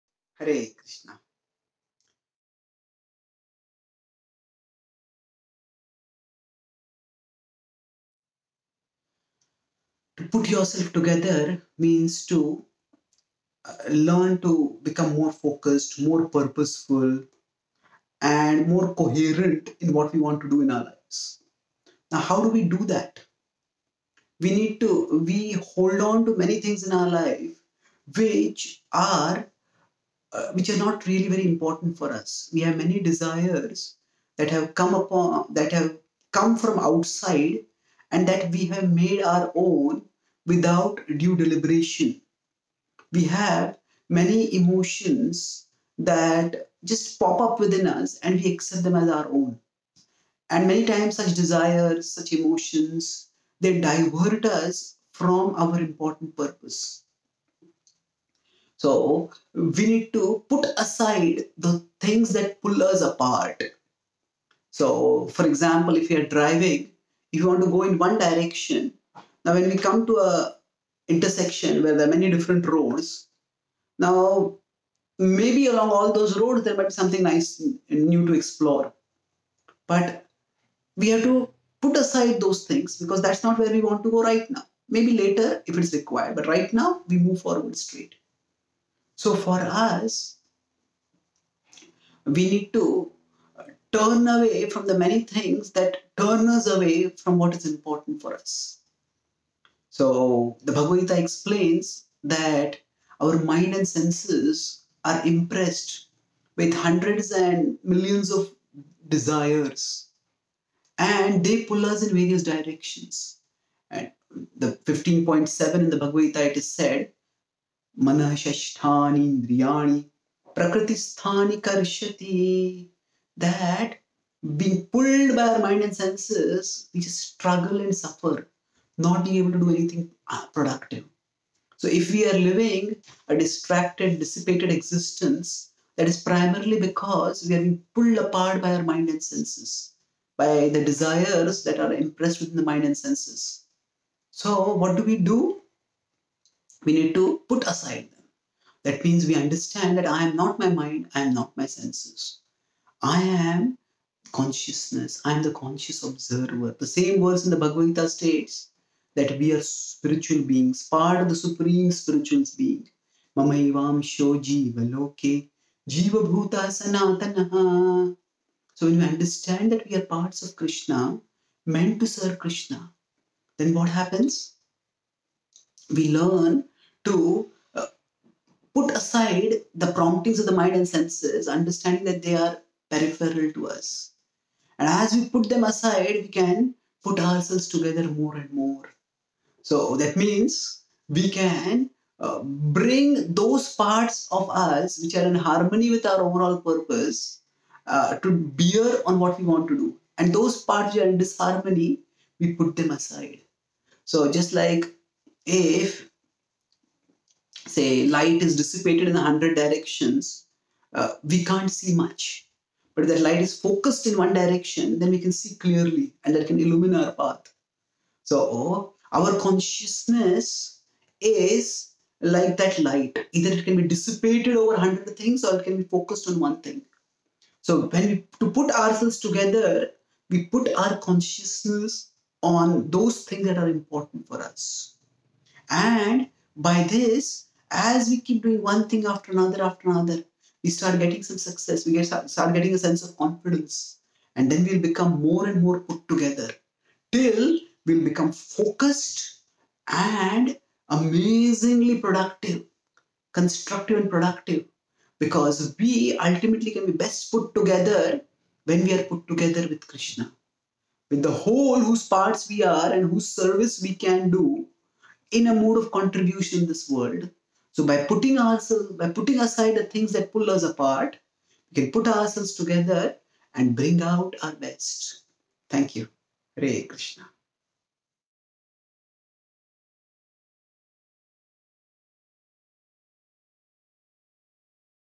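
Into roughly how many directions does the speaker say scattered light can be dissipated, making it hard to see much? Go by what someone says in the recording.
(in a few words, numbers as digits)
100.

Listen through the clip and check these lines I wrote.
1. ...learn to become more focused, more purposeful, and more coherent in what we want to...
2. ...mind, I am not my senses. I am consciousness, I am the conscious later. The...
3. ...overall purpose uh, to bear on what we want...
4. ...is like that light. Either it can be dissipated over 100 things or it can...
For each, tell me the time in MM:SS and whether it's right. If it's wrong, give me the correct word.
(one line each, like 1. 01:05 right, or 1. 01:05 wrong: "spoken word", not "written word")
1. 00:13 right
2. 02:30 wrong: "observer", not "later"
3. 03:16 right
4. 03:41 right.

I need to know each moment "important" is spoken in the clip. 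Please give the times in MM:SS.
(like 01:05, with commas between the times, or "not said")
00:31, 00:55, 01:37, 03:53.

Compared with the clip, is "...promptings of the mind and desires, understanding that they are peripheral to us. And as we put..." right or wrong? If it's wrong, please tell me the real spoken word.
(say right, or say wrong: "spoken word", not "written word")
wrong: "senses", not "desires".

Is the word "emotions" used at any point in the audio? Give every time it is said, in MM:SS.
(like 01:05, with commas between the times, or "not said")
00:44, 00:52.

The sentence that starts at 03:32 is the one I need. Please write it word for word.
But if that light is focused in one direction, then we can see clearly and that can illumine our path.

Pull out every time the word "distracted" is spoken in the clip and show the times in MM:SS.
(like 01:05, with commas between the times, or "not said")
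02:13.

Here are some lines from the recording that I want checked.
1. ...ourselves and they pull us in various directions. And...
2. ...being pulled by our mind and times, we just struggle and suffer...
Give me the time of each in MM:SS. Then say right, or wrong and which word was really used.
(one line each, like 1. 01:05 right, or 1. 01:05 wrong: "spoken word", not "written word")
1. 01:49 wrong: "desires", not "ourselves"
2. 02:04 wrong: "senses", not "times".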